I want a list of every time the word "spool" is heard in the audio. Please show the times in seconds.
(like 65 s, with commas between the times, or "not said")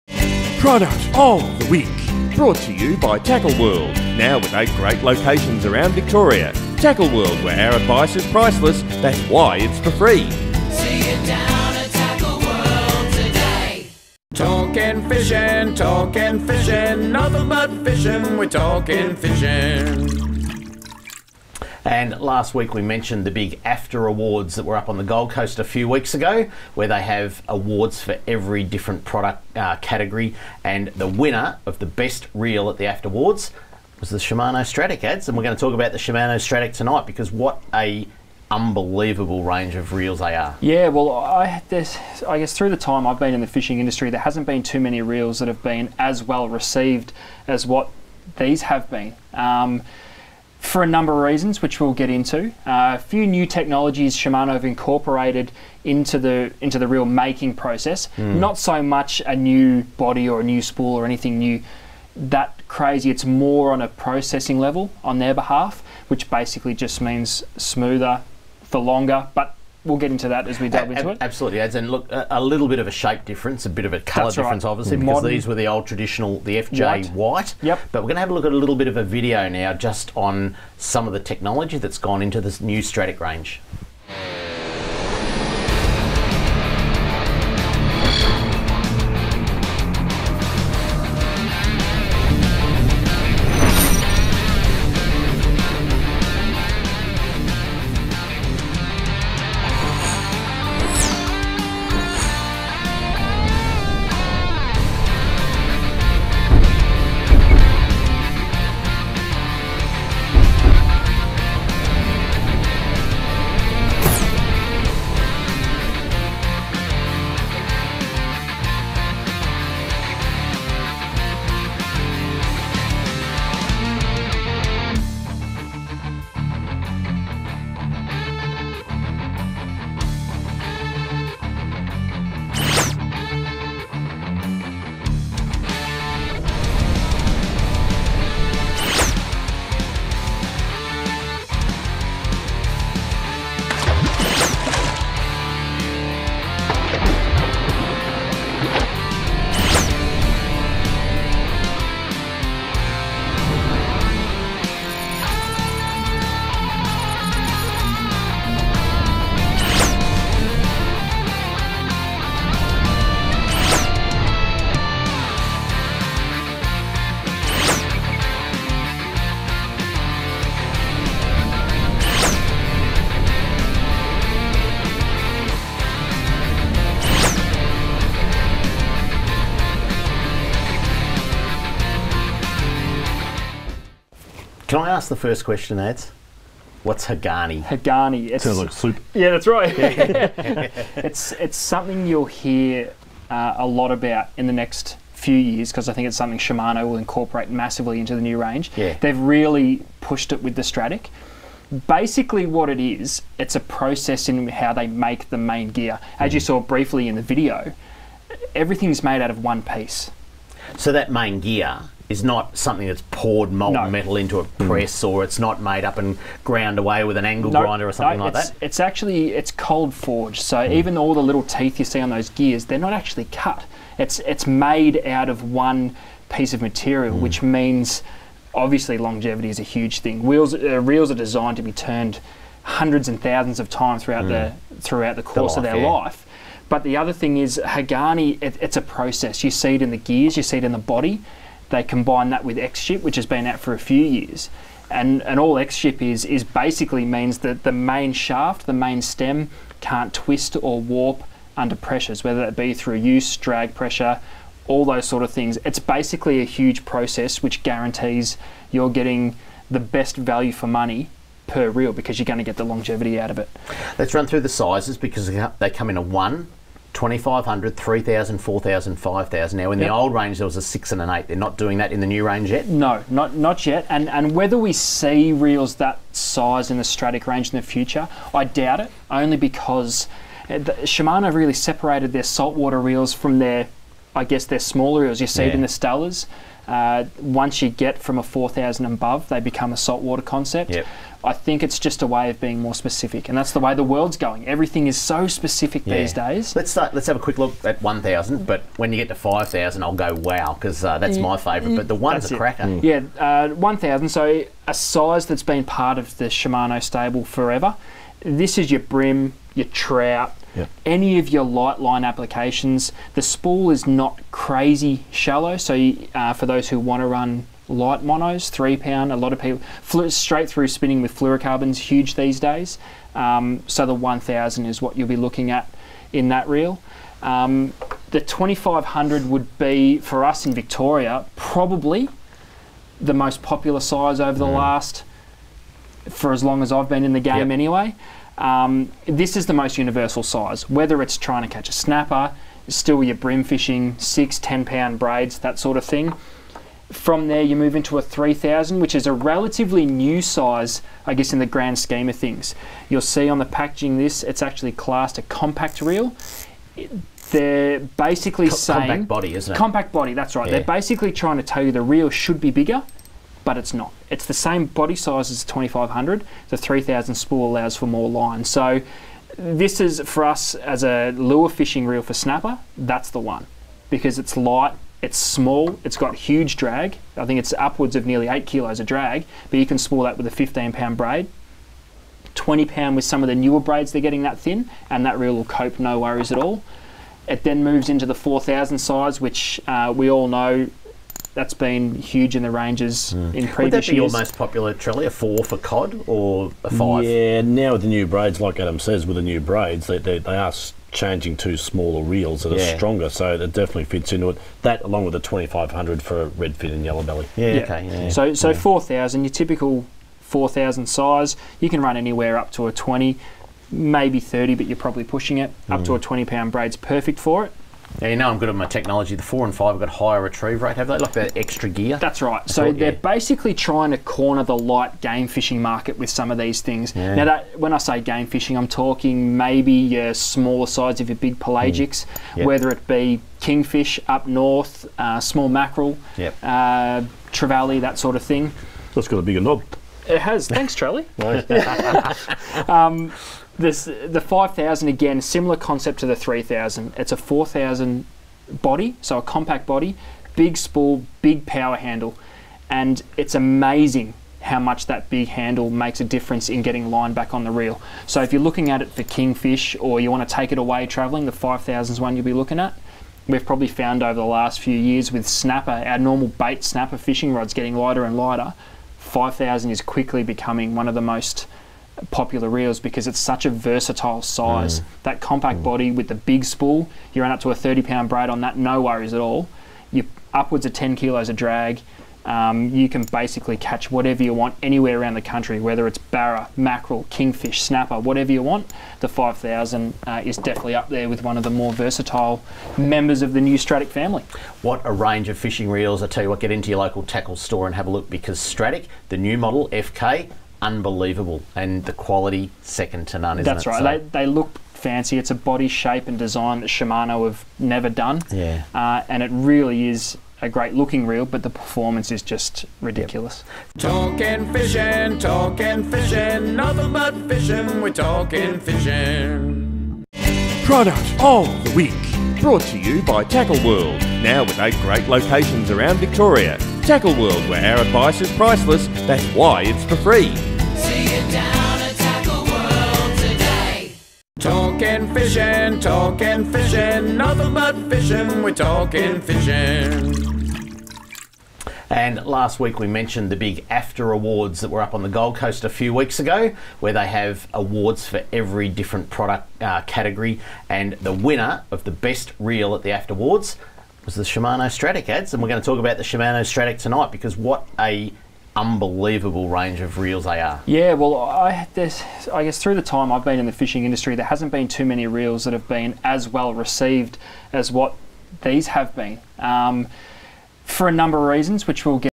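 60 s, 313 s, 367 s, 379 s, 450 s, 476 s.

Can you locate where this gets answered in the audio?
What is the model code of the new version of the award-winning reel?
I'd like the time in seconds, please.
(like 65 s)
499 s.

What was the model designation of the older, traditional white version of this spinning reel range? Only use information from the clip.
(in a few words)
FJ.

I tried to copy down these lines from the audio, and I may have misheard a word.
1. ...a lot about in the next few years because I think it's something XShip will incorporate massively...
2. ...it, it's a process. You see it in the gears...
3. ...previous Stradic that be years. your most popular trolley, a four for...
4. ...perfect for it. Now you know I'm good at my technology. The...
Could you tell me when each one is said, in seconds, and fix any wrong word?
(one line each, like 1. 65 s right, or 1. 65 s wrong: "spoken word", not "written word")
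1. 193 s wrong: "Shimano", not "XShip"
2. 238 s right
3. 393 s wrong: "Would", not "Stradic"
4. 416 s right.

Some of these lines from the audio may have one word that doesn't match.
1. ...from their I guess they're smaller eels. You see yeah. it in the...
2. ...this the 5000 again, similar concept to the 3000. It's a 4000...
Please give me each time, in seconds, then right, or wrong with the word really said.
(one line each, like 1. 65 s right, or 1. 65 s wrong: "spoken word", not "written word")
1. 283 s right
2. 443 s right.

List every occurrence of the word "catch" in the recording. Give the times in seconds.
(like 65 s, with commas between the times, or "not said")
341 s, 483 s.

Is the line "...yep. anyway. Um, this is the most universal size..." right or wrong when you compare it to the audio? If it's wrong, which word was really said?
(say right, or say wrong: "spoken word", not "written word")
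right.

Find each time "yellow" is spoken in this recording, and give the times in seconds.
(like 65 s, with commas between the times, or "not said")
406 s.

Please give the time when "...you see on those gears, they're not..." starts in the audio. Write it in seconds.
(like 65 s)
221 s.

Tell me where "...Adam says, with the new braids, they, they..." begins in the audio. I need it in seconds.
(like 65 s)
398 s.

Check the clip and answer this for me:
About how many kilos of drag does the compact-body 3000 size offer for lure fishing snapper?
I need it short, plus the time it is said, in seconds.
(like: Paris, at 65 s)
nearly 8 kilos, at 378 s.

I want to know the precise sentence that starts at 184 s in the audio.
Can I ask the first question, Ads?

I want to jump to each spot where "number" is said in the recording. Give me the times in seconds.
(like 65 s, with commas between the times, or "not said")
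50 s, 570 s.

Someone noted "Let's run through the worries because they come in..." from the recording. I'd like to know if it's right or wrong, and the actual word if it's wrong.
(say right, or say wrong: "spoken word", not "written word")
wrong: "sizes", not "worries".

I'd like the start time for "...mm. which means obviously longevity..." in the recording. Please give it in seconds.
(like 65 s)
227 s.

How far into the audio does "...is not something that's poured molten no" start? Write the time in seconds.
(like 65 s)
212 s.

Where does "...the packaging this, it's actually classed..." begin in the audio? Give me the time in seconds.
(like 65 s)
353 s.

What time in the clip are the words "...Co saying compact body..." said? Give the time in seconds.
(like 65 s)
358 s.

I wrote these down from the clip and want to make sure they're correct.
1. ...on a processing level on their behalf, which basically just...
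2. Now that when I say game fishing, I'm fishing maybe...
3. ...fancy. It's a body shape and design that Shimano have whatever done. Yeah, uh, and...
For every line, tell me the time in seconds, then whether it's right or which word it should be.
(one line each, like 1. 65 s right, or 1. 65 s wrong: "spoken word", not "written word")
1. 63 s right
2. 427 s wrong: "talking", not "fishing"
3. 504 s wrong: "never", not "whatever".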